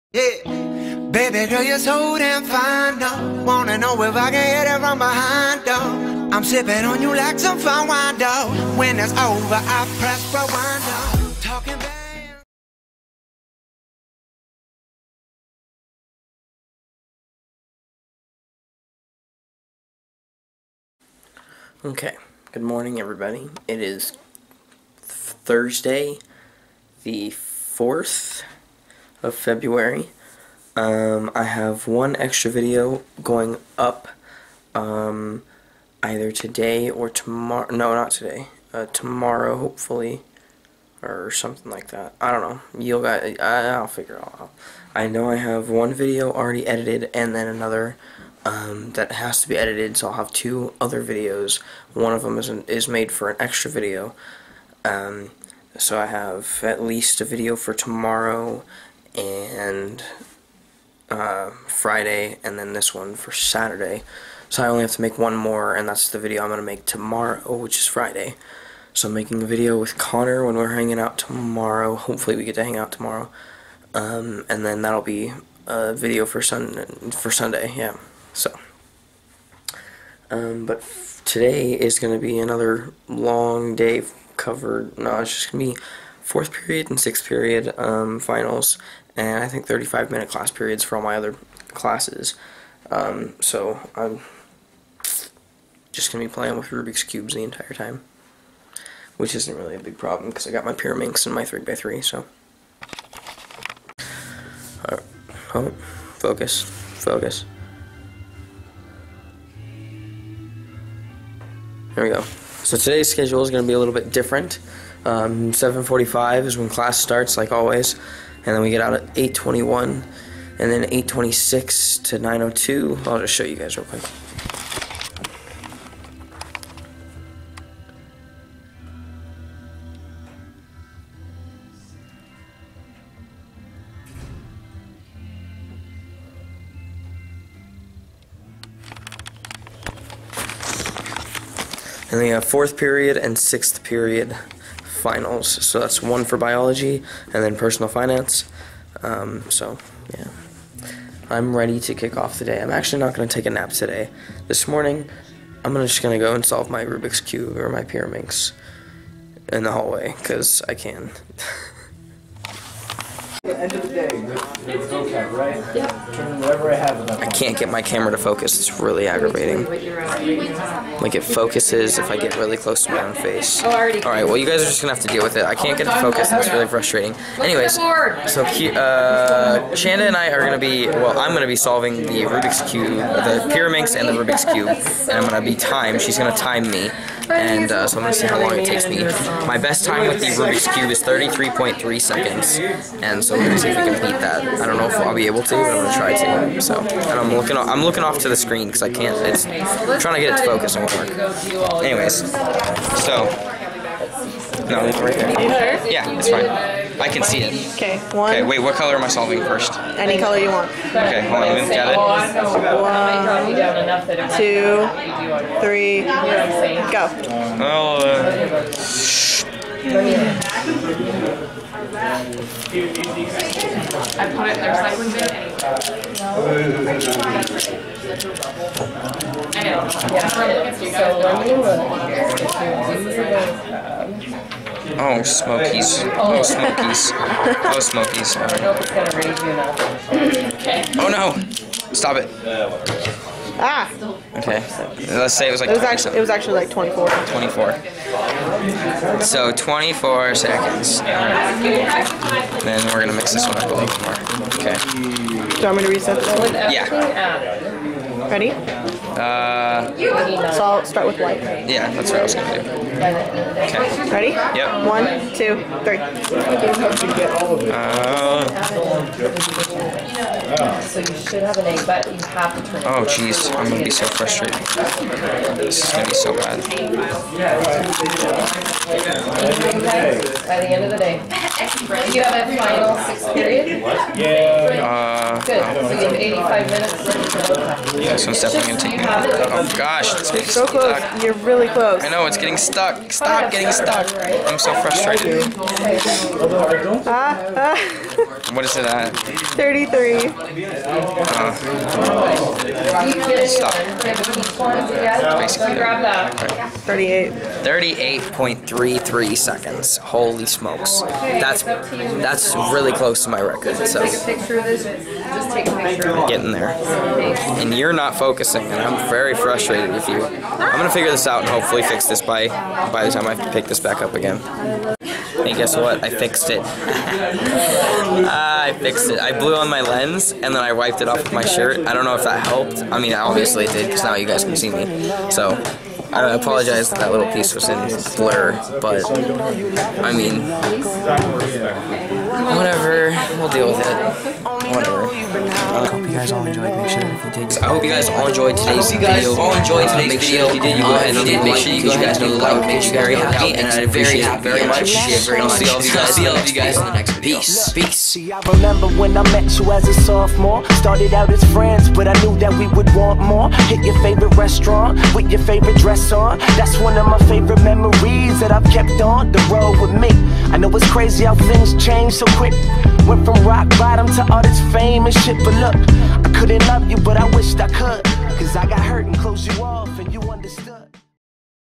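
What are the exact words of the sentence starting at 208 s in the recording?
Okay, wait, what color am I solving first?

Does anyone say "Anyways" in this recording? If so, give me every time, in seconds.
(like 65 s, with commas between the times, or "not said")
177 s, 201 s.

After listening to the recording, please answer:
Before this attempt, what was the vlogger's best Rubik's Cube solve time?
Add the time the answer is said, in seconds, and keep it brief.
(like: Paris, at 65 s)
33.3 seconds, at 191 s.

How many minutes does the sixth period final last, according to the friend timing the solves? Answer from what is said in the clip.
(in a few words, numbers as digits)
85.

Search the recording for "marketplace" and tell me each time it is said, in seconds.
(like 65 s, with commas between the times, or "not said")
not said.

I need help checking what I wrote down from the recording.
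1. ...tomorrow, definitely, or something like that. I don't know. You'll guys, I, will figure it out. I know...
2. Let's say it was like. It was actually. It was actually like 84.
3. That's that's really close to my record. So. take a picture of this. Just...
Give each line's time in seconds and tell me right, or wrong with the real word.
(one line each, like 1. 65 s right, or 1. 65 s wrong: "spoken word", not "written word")
1. 38 s wrong: "hopefully", not "definitely"
2. 245 s wrong: "24", not "84"
3. 311 s right.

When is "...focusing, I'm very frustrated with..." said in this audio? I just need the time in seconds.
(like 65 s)
318 s.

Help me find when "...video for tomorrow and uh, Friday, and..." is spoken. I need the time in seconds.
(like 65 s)
57 s.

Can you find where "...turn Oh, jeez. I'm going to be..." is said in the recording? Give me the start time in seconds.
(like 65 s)
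272 s.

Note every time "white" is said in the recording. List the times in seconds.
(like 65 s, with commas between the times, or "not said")
261 s.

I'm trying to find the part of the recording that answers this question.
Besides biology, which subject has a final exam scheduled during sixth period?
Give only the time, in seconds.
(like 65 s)
147 s.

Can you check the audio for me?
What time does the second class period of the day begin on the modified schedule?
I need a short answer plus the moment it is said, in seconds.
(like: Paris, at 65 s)
8:26, at 120 s.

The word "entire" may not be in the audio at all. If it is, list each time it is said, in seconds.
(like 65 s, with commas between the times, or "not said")
97 s.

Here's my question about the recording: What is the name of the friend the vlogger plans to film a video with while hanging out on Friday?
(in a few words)
Connor.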